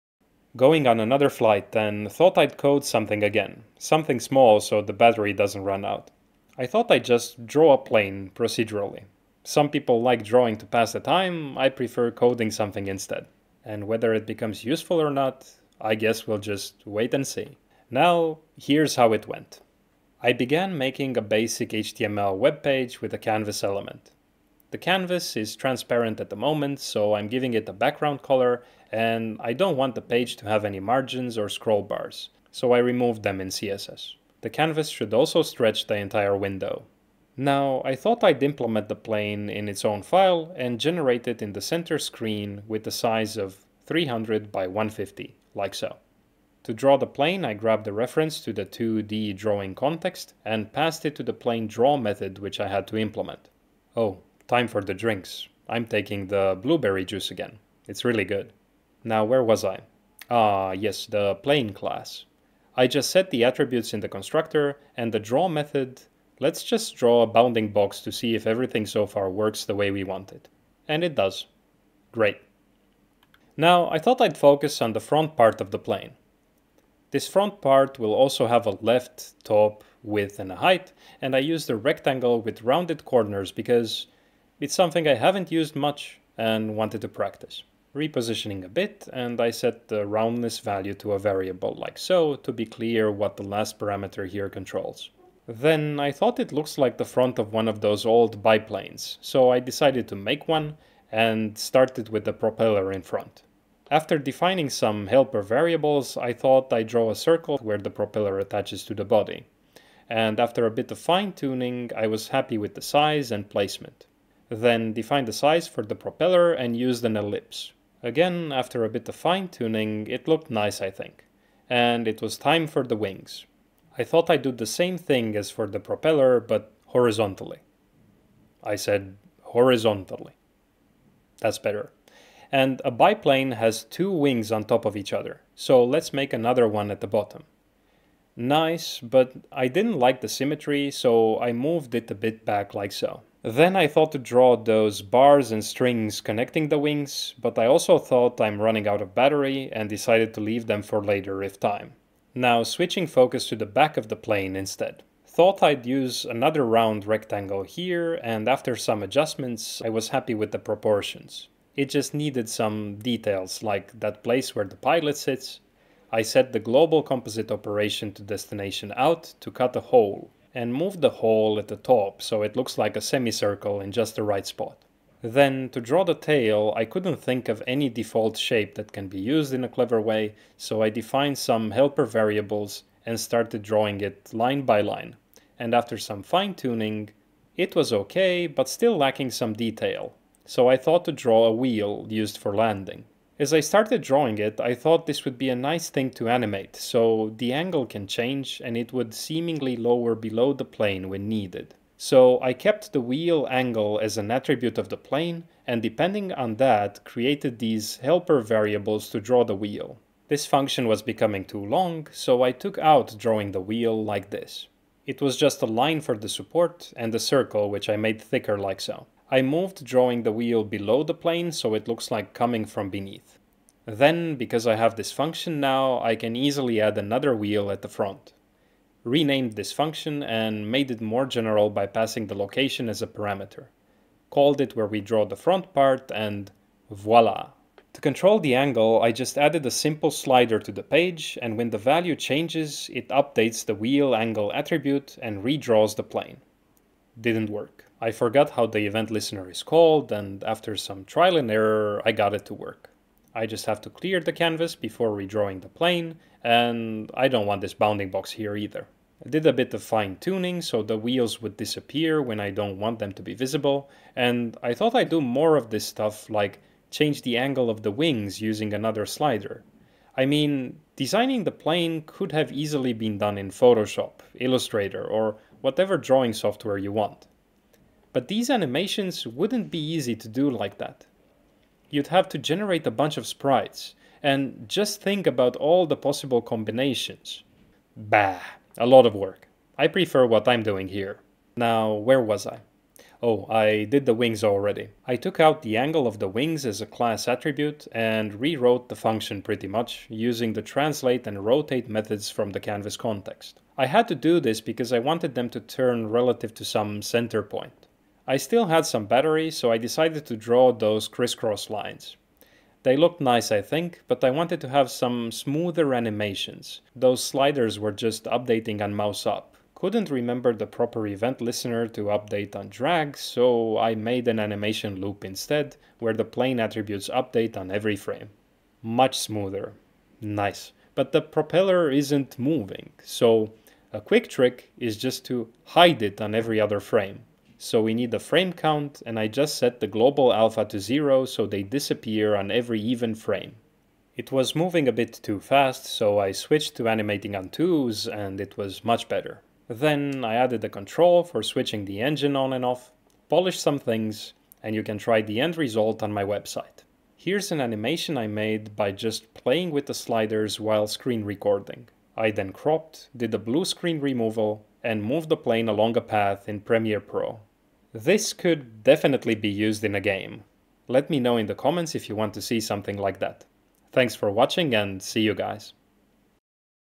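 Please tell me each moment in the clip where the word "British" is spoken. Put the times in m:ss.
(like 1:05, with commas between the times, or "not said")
not said.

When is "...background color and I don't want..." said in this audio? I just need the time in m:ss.
0:27.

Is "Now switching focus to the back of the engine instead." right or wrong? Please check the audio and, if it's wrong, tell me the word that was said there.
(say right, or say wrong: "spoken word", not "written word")
wrong: "plane", not "engine".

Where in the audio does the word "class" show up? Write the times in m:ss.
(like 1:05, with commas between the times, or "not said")
1:01, 4:56.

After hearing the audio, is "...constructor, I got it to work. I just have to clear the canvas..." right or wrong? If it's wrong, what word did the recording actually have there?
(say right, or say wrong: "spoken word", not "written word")
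wrong: "error", not "constructor".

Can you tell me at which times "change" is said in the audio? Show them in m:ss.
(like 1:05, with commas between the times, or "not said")
3:18, 4:02, 4:26.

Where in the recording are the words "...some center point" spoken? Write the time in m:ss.
5:06.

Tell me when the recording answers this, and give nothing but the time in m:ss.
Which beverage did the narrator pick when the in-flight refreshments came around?
0:56.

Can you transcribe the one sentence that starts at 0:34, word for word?
The canvas should also stretch the entire window.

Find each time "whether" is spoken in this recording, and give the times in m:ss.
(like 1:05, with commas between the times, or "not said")
0:13.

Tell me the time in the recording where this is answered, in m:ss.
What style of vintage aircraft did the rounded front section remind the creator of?
1:38.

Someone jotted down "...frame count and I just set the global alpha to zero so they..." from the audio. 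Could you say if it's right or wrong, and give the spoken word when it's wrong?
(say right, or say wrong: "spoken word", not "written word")
right.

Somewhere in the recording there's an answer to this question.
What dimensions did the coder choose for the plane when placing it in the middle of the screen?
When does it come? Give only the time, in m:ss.
0:43.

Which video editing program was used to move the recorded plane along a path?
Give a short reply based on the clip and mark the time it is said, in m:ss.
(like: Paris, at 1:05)
Premiere Pro, at 6:06.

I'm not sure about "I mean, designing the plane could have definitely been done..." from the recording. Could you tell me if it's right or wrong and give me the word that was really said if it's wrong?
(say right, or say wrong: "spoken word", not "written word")
wrong: "easily", not "definitely".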